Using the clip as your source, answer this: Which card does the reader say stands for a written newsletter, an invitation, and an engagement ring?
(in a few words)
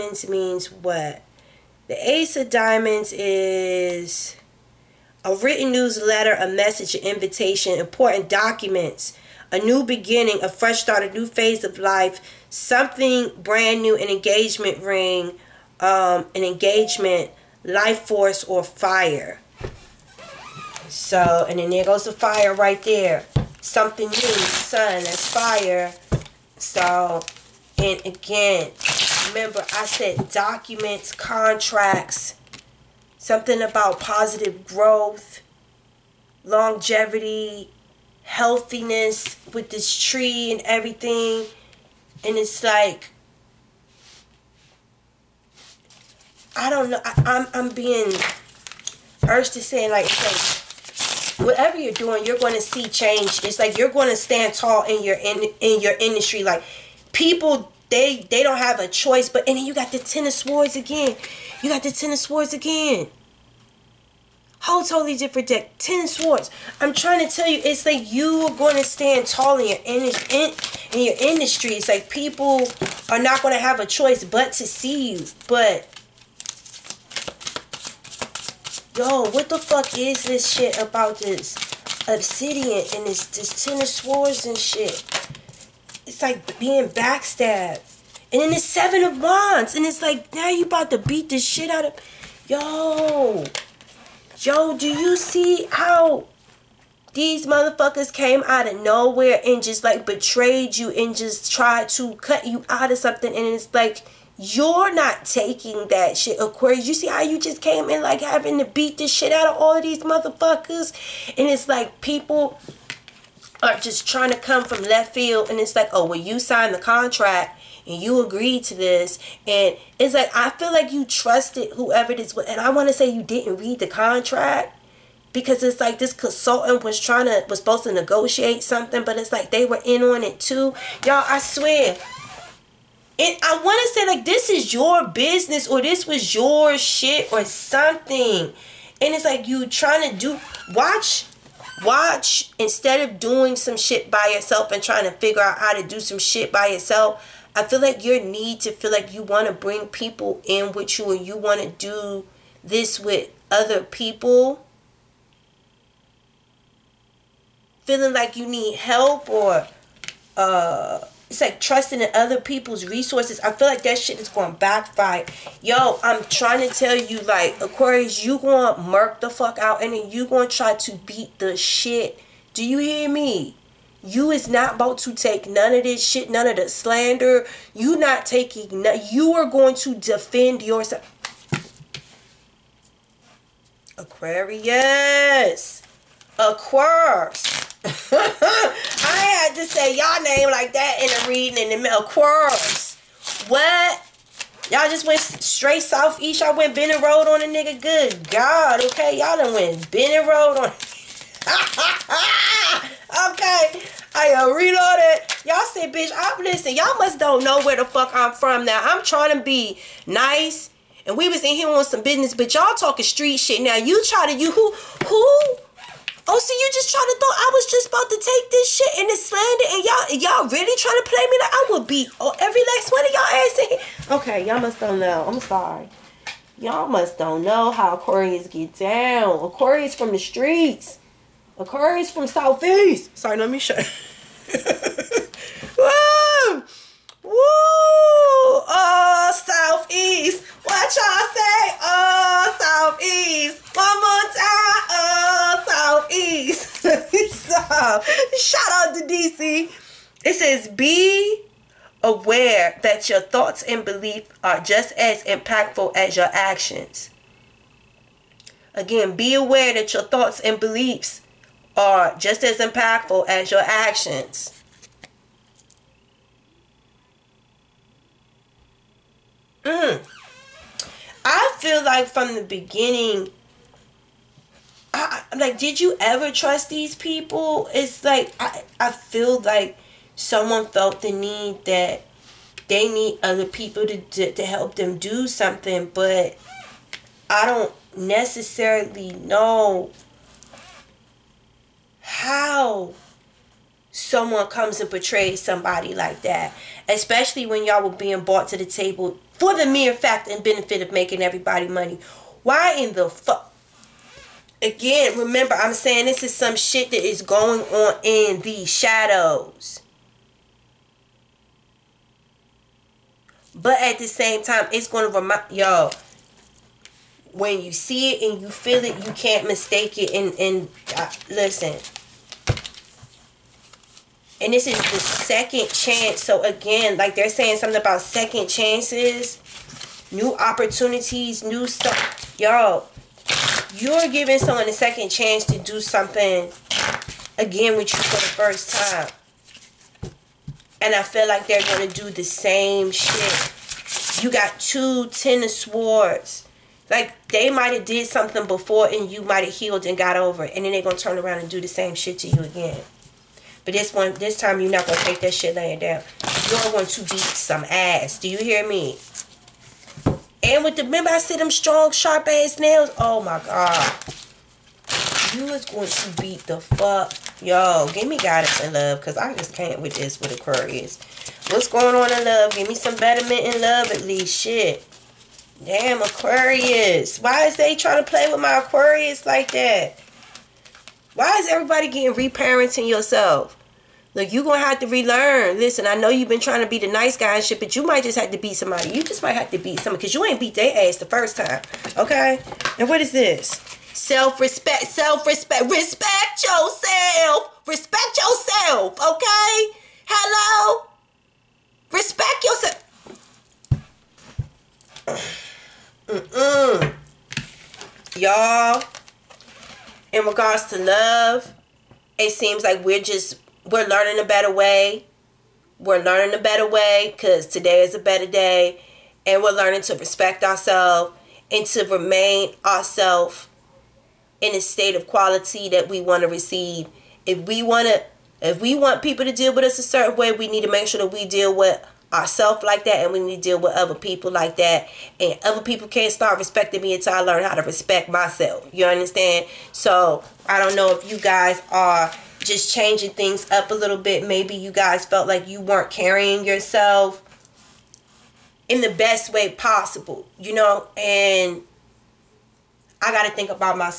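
Ace of Diamonds.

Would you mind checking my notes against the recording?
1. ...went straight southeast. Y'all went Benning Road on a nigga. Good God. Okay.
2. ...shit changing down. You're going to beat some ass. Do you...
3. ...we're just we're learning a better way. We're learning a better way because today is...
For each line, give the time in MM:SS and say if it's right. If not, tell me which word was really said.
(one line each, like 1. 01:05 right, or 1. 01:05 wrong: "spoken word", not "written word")
1. 03:15 right
2. 05:55 wrong: "laying", not "changing"
3. 06:52 right.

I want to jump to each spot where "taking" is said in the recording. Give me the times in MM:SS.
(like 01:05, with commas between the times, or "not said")
01:45, 02:58.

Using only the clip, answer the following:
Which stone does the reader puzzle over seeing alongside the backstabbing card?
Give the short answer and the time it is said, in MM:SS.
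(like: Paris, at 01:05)
Obsidian, at 01:22.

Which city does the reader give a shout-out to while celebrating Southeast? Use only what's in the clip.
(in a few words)
DC.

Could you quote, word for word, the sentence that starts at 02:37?
Feeling like you need help or uh, it's like trusting in other people's resources.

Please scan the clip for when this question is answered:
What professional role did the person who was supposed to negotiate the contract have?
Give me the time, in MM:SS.
02:06.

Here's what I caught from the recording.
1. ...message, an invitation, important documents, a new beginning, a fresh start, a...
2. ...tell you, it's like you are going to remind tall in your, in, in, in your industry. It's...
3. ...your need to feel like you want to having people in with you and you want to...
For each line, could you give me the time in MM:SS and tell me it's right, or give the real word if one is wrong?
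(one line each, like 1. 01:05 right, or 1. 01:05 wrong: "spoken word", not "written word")
1. 00:06 right
2. 01:07 wrong: "stand", not "remind"
3. 02:28 wrong: "bring", not "having".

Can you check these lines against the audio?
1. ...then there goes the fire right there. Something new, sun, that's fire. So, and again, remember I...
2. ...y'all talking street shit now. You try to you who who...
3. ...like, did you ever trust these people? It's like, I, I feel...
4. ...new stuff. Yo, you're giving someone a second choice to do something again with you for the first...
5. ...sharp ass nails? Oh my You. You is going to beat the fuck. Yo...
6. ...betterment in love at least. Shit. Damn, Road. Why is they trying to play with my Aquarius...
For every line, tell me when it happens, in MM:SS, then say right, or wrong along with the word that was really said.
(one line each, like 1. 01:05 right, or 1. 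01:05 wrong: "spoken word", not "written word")
1. 00:21 right
2. 03:32 right
3. 04:35 right
4. 05:31 wrong: "chance", not "choice"
5. 06:01 wrong: "God", not "You"
6. 06:12 wrong: "Aquarius", not "Road".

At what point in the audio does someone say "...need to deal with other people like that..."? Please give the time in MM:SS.
07:13.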